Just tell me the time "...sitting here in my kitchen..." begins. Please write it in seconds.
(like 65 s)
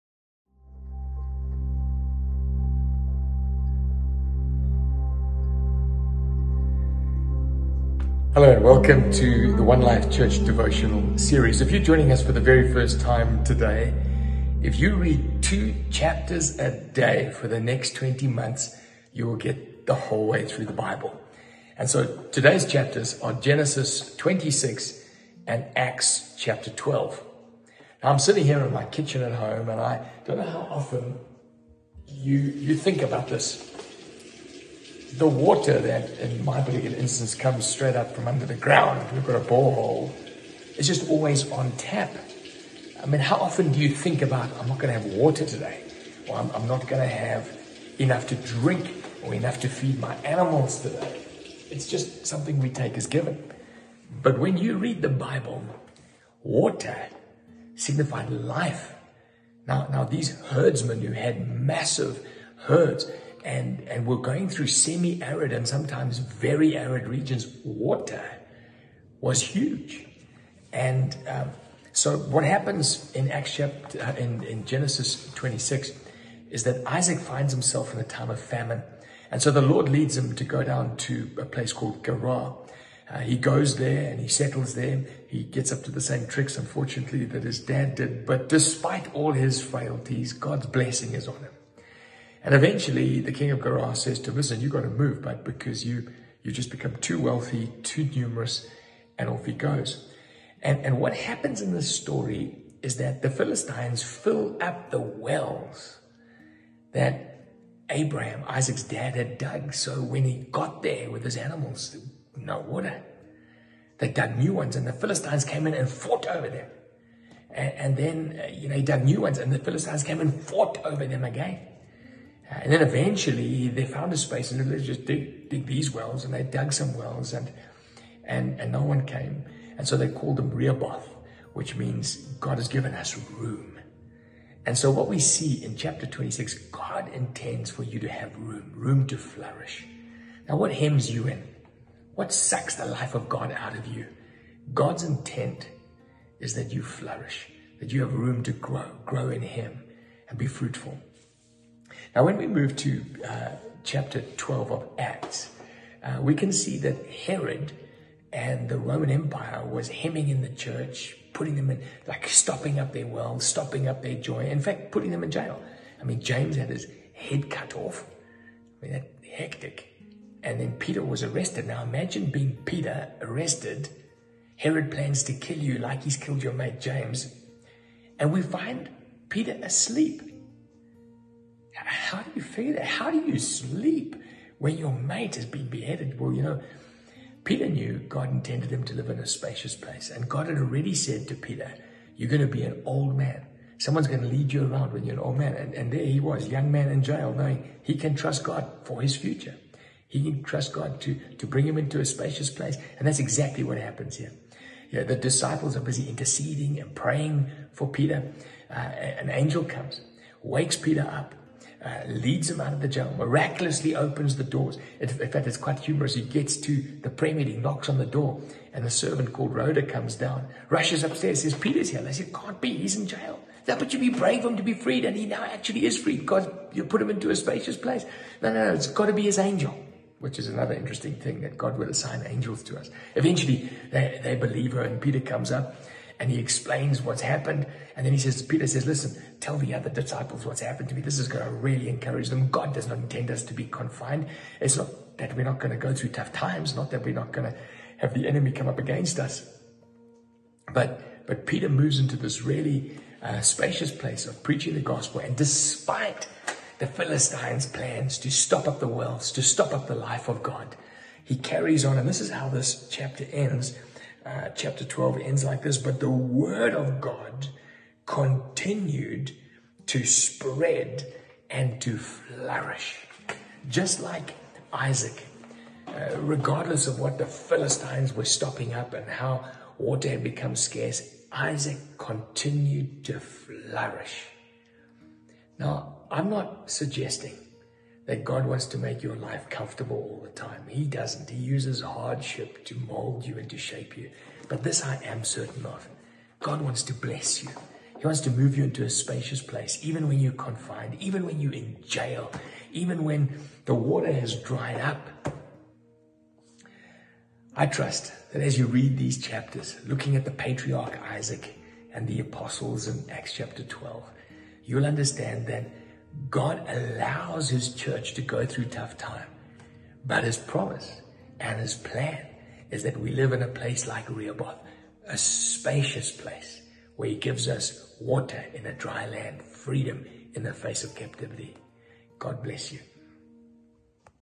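28 s.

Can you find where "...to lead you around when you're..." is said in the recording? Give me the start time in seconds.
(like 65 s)
194 s.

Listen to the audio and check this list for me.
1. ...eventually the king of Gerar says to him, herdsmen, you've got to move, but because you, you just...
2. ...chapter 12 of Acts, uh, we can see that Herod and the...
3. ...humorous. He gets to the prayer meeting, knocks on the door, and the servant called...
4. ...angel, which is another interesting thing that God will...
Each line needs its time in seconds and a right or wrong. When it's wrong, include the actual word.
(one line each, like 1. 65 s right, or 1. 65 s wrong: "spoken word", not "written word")
1. 92 s wrong: "listen", not "herdsmen"
2. 153 s right
3. 215 s right
4. 229 s right.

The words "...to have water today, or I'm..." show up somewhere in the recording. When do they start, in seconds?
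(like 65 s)
44 s.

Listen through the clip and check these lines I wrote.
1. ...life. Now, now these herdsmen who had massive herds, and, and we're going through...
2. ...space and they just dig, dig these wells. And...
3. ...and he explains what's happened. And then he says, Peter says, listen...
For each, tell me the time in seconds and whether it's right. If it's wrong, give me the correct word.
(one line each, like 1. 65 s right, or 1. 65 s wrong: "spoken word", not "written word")
1. 58 s right
2. 124 s right
3. 236 s right.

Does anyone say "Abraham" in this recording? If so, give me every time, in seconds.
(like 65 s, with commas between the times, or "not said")
107 s.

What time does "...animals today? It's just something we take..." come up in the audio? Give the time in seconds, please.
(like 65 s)
50 s.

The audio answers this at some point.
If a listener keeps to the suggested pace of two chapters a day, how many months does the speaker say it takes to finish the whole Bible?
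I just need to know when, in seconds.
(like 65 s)
17 s.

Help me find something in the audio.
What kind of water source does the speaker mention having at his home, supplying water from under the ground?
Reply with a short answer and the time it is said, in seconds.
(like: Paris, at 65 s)
A borehole, at 39 s.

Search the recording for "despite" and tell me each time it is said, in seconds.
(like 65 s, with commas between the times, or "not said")
88 s, 255 s.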